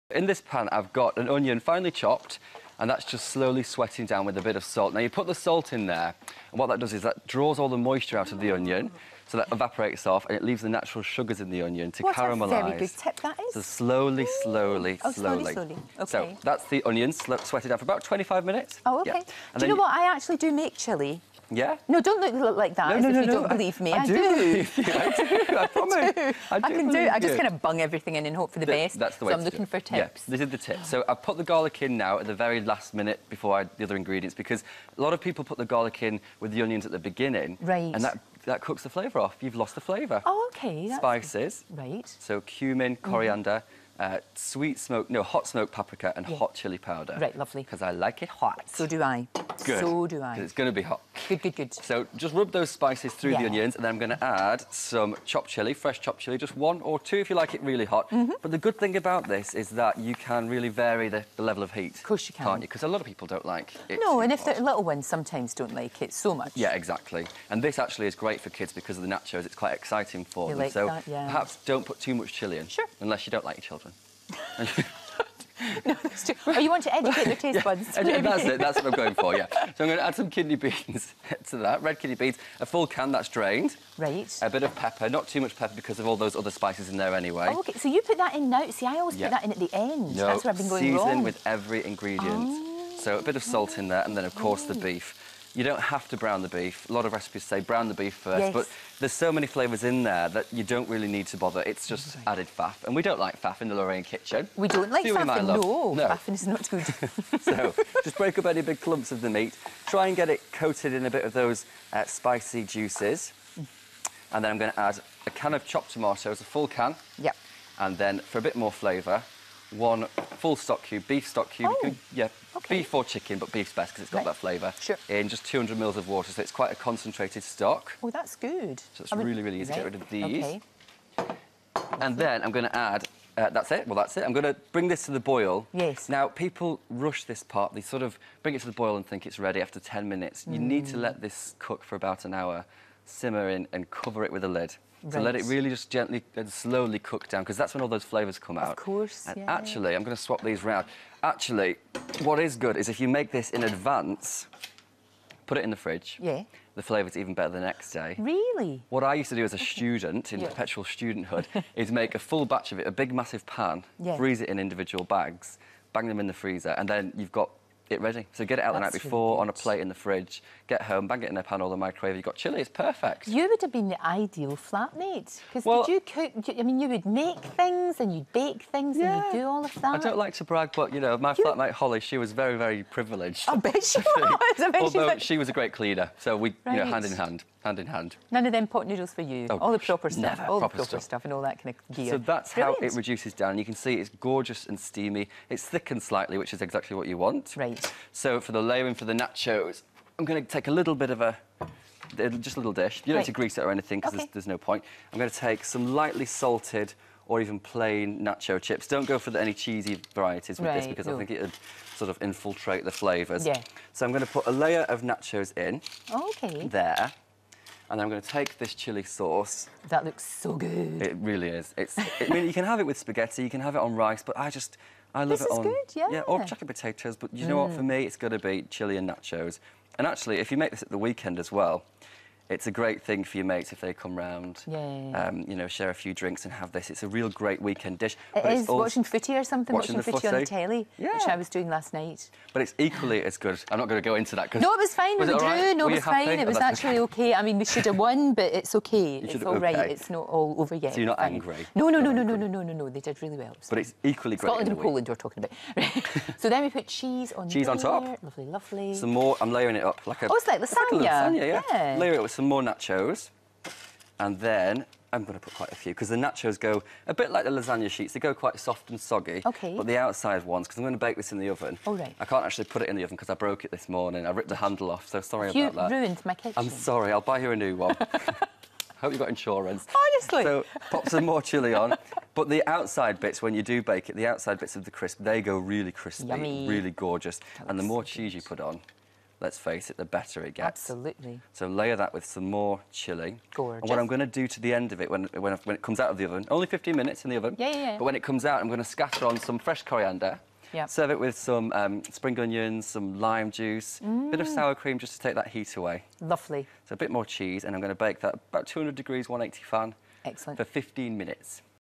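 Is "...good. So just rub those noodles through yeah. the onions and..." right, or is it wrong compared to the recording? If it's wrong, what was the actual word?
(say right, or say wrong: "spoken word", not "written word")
wrong: "spices", not "noodles".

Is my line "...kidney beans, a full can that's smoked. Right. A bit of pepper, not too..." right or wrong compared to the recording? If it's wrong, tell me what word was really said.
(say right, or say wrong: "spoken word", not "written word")
wrong: "drained", not "smoked".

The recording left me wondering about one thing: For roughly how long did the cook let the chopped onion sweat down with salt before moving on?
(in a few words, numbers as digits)
25 minutes.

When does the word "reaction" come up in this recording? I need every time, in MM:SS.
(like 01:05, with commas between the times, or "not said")
not said.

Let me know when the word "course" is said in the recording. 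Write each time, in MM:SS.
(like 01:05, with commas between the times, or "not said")
01:02, 01:34, 02:28.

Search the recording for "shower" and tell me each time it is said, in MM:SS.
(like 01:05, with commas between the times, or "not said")
not said.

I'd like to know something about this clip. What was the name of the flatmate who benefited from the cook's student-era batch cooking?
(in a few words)
Holly.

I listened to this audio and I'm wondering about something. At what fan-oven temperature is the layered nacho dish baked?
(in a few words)
180 degrees.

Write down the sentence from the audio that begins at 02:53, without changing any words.
You would have been the ideal flatmate.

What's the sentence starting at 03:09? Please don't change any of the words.
Oh, all the proper stuff, all proper the proper stuff.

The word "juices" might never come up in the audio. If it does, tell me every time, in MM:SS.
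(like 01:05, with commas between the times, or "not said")
01:52, 05:03.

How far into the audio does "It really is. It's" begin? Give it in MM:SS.
03:41.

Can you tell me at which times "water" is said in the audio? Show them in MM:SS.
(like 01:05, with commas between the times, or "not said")
02:06.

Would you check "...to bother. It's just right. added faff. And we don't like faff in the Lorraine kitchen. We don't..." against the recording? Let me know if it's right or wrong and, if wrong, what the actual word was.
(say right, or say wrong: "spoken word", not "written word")
right.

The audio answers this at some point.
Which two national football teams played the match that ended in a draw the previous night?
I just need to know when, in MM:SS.
04:14.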